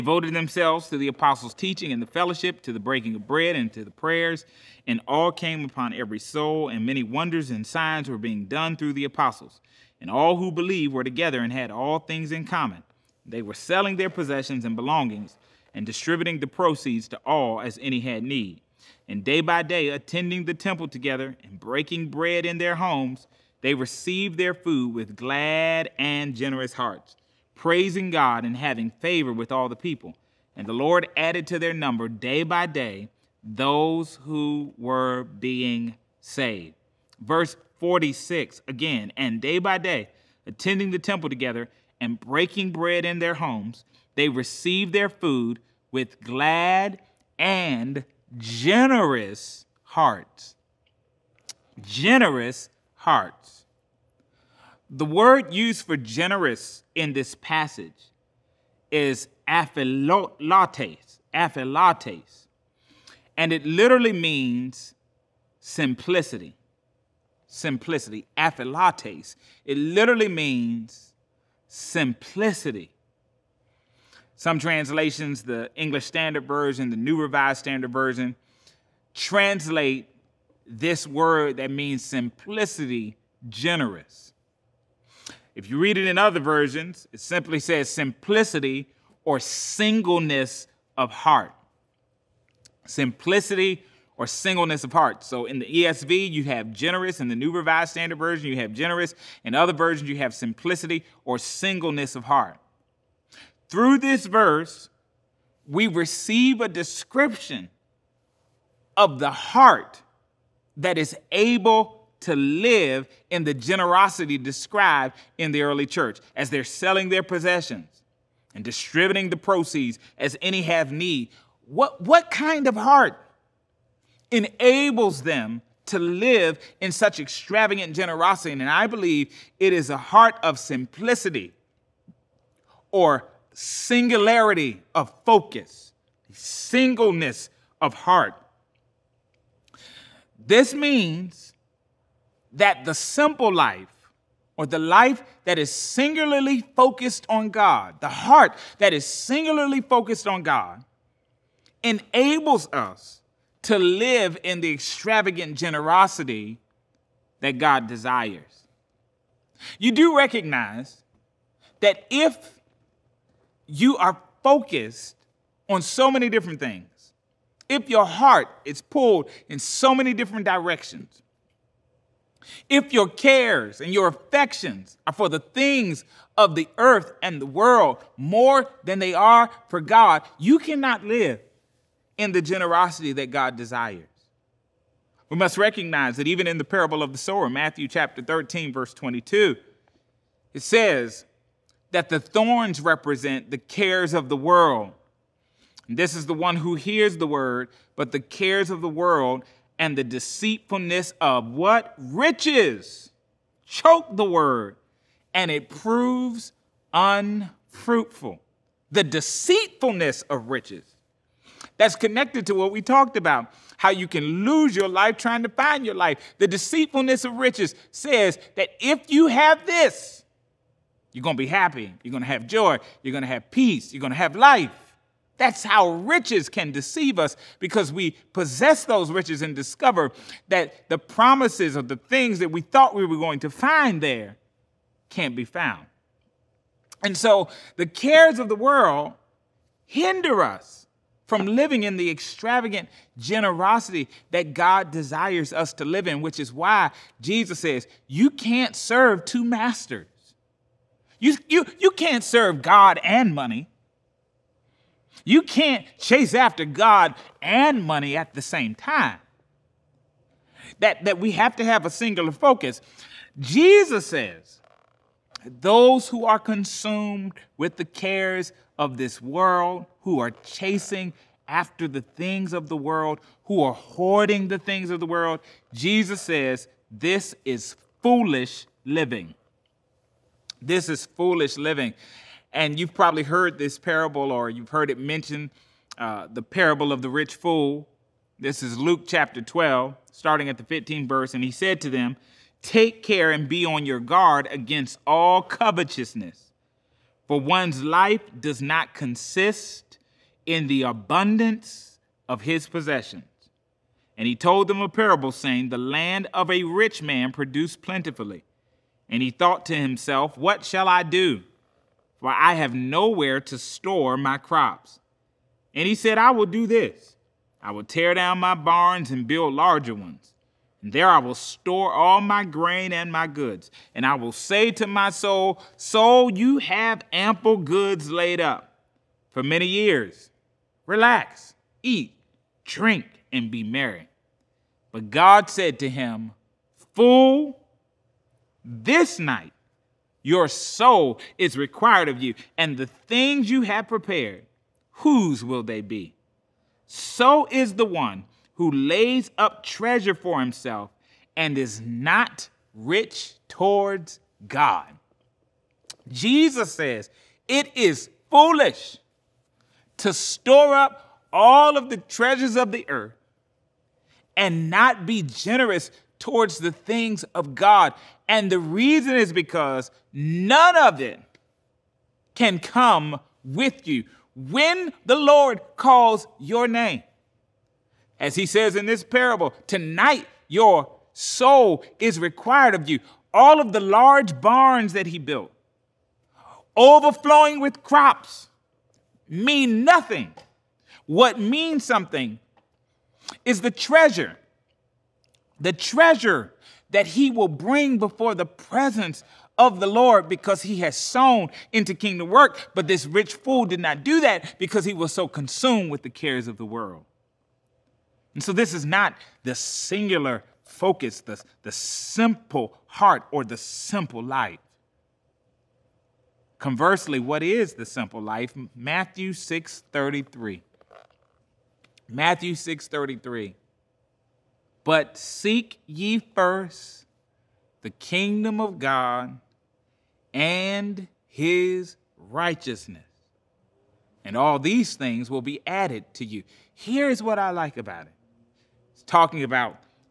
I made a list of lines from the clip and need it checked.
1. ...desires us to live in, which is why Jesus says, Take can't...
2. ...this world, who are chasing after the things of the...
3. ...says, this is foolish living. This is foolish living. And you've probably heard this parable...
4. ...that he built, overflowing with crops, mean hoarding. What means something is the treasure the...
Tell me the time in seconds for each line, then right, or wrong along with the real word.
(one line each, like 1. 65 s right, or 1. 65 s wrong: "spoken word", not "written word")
1. 244 s wrong: "You", not "Take"
2. 268 s right
3. 276 s right
4. 384 s wrong: "nothing", not "hoarding".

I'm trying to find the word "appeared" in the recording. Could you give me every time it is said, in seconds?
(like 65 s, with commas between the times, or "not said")
not said.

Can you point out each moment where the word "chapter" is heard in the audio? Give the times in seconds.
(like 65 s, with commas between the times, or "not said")
187 s, 289 s.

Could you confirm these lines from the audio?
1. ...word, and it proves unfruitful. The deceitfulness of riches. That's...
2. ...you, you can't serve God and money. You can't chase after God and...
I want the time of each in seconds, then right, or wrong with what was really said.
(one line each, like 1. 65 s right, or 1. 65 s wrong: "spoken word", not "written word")
1. 204 s right
2. 251 s right.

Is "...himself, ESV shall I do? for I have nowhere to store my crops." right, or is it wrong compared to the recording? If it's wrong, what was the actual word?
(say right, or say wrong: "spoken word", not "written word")
wrong: "What", not "ESV".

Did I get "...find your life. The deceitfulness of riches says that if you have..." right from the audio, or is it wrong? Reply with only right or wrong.
right.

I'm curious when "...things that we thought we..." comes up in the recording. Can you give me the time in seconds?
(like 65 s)
231 s.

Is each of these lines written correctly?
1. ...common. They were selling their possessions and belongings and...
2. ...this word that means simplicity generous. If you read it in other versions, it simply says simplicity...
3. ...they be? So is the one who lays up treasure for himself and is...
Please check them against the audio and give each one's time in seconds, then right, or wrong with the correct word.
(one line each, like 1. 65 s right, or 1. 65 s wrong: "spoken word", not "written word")
1. 12 s right
2. 80 s right
3. 345 s right.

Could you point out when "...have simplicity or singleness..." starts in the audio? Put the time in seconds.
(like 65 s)
100 s.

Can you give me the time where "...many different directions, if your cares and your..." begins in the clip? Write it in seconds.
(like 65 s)
169 s.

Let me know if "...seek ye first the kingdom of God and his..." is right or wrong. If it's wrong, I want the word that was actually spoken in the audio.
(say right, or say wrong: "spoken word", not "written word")
right.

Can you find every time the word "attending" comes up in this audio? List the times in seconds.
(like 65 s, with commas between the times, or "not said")
19 s, 40 s.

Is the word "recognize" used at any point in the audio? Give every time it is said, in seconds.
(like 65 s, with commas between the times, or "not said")
160 s, 185 s.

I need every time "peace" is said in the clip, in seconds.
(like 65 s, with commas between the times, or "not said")
223 s.